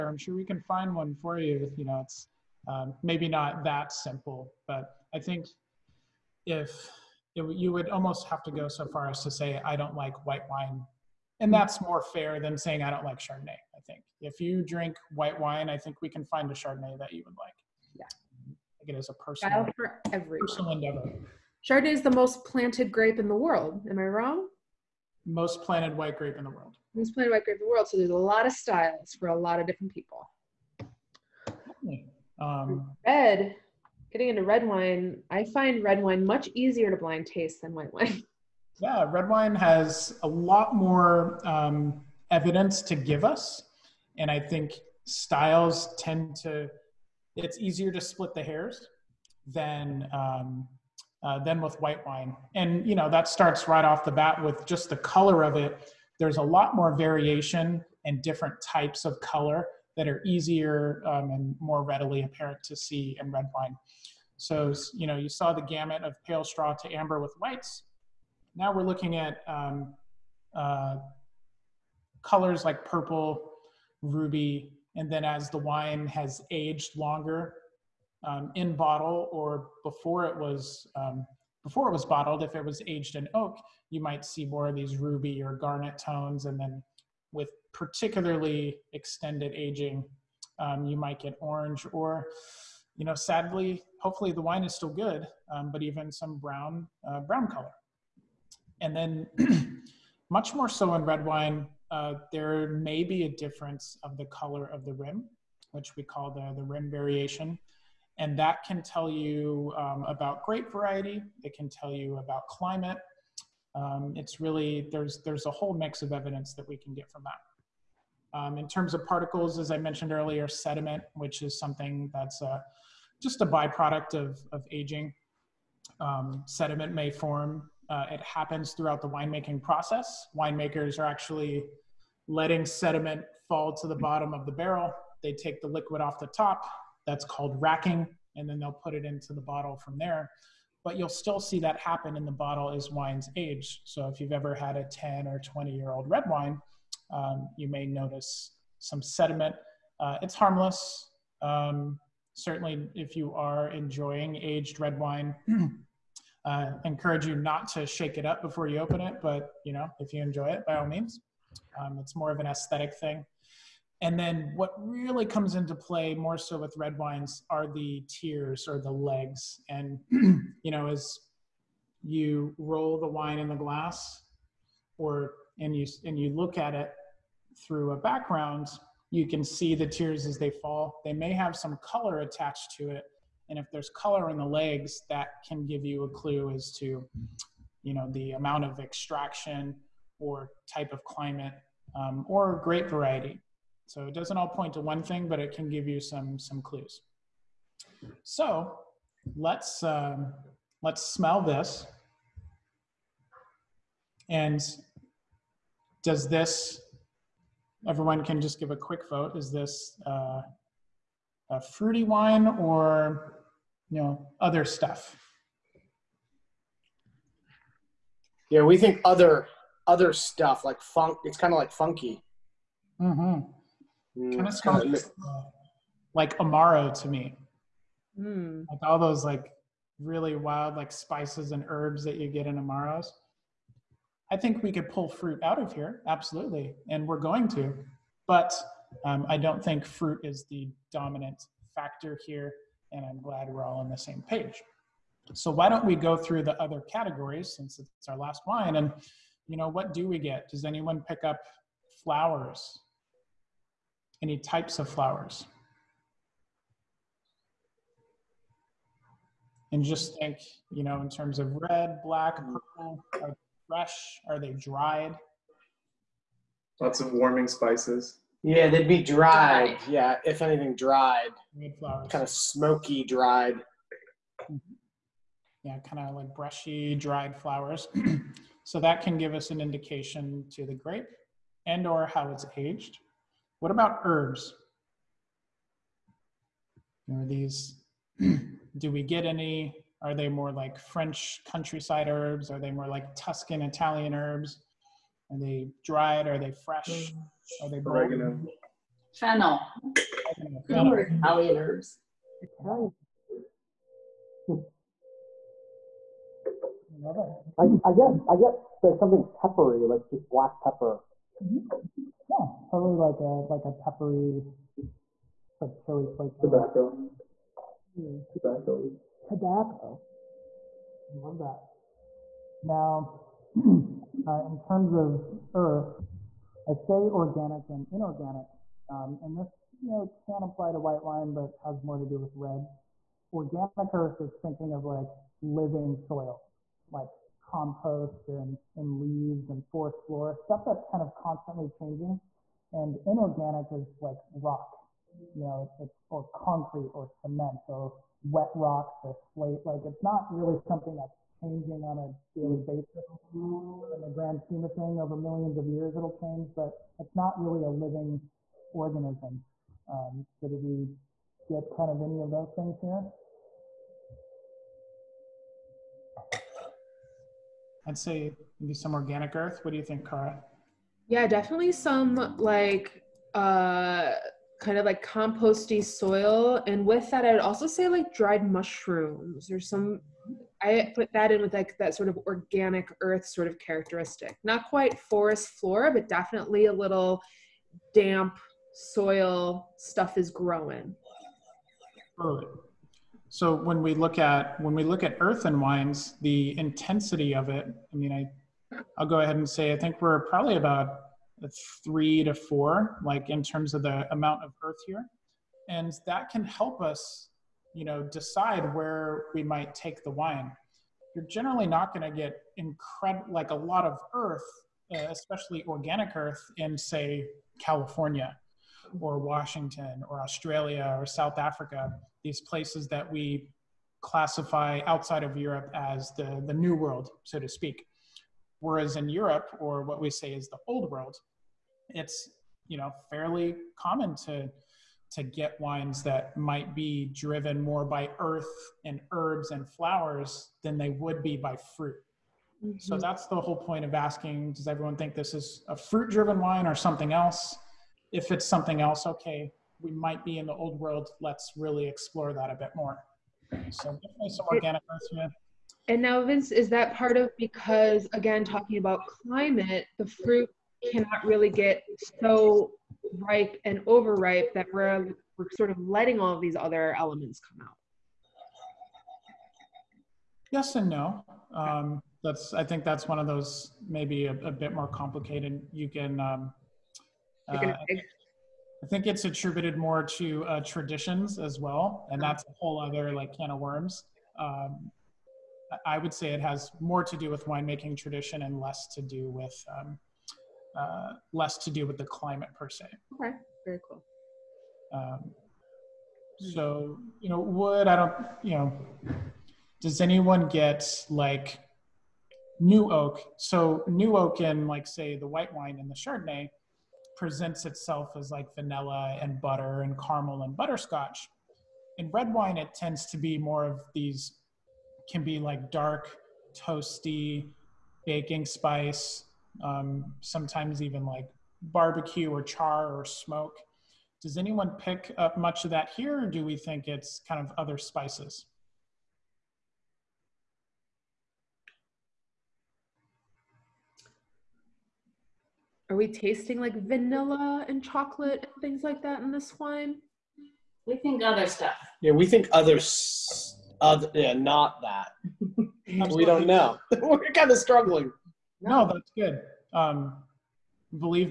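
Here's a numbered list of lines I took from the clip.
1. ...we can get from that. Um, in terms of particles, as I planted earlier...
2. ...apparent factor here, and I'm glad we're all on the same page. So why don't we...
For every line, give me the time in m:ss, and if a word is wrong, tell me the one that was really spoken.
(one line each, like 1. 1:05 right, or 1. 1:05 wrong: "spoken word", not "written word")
1. 1:56 wrong: "mentioned", not "planted"
2. 4:00 wrong: "dominant", not "apparent".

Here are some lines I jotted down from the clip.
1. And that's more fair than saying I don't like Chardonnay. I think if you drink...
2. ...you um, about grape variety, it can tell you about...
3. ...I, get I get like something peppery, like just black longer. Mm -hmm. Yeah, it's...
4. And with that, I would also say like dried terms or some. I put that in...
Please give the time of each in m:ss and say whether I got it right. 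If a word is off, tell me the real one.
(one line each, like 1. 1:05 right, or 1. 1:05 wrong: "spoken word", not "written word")
1. 0:11 right
2. 1:49 right
3. 5:07 wrong: "pepper", not "longer"
4. 6:16 wrong: "mushrooms", not "terms".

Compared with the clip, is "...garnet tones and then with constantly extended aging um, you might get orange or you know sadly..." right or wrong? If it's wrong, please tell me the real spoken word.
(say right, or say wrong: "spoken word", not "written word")
wrong: "particularly", not "constantly".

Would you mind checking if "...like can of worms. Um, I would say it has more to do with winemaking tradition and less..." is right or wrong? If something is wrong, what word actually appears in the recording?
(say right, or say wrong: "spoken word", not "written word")
right.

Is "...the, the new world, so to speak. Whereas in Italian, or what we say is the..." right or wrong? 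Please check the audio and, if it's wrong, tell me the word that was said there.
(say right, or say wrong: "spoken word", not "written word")
wrong: "Europe", not "Italian".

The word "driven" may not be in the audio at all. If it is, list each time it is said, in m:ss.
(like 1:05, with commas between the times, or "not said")
7:17, 7:26.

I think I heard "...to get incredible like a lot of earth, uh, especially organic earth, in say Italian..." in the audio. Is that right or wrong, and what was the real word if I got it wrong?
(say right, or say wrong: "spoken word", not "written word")
wrong: "California", not "Italian".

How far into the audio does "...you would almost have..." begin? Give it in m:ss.
0:07.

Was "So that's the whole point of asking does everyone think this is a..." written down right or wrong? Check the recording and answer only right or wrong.
right.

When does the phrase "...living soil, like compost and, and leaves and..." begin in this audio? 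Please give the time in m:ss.
5:35.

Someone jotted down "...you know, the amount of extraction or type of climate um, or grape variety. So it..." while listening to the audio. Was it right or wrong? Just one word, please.
right.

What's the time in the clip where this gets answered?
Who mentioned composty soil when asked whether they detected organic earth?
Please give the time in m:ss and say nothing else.
6:09.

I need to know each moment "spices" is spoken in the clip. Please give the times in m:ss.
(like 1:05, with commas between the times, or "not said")
3:50, 4:27, 8:38, 8:47.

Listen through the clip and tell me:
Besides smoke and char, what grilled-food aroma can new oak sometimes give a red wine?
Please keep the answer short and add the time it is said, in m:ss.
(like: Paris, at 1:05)
barbecue, at 8:41.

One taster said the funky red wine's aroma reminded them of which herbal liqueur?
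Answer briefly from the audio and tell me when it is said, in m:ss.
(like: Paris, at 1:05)
amaro, at 3:46.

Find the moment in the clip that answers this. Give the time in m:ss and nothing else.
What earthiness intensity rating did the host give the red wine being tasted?
6:41.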